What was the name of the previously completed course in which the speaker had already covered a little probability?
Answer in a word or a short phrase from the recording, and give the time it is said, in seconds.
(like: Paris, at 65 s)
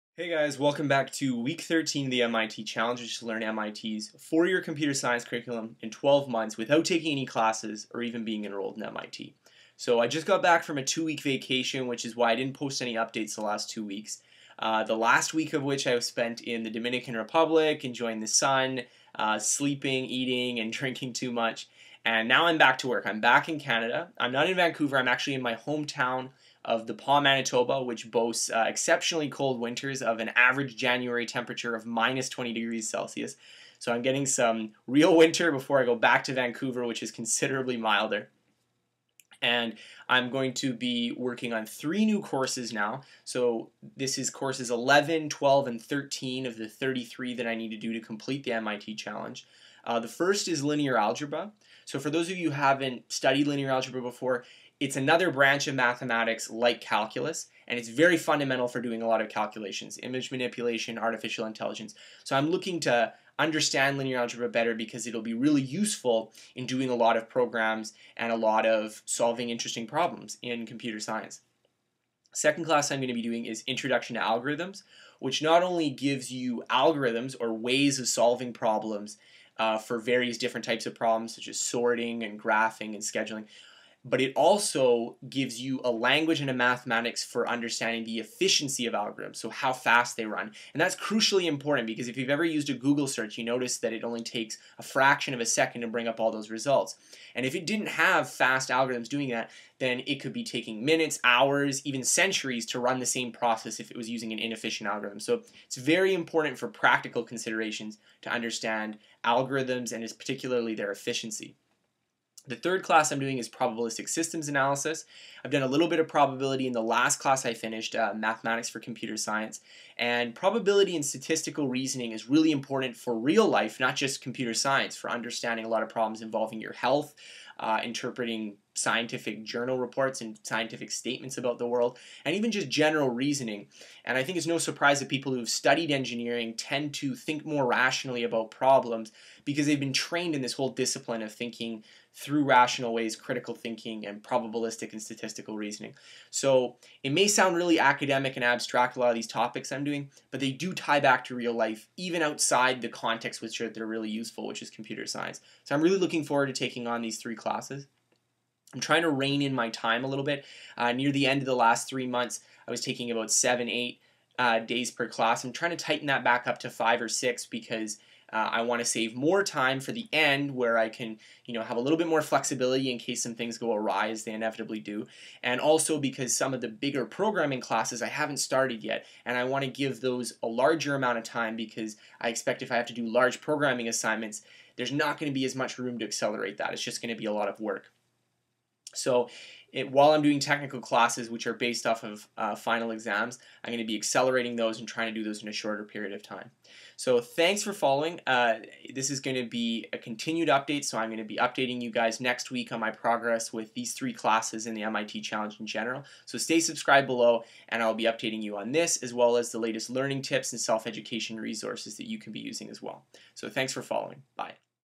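Mathematics for Computer Science, at 118 s.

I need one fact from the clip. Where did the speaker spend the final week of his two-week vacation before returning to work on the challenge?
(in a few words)
Dominican Republic.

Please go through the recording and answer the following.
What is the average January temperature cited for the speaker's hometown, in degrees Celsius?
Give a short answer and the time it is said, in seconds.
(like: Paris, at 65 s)
-20, at 31 s.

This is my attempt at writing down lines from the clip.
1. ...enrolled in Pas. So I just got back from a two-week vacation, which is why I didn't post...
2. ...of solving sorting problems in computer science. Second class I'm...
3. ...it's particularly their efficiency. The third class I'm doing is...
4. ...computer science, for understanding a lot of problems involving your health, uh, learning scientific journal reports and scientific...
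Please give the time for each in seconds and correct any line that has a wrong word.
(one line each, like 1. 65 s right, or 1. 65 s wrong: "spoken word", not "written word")
1. 8 s wrong: "MIT", not "Pas"
2. 68 s wrong: "interesting", not "sorting"
3. 110 s right
4. 124 s wrong: "interpreting", not "learning".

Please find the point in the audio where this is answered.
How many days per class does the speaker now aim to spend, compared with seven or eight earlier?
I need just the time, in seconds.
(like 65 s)
166 s.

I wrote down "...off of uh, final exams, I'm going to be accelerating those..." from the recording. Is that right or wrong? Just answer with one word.
right.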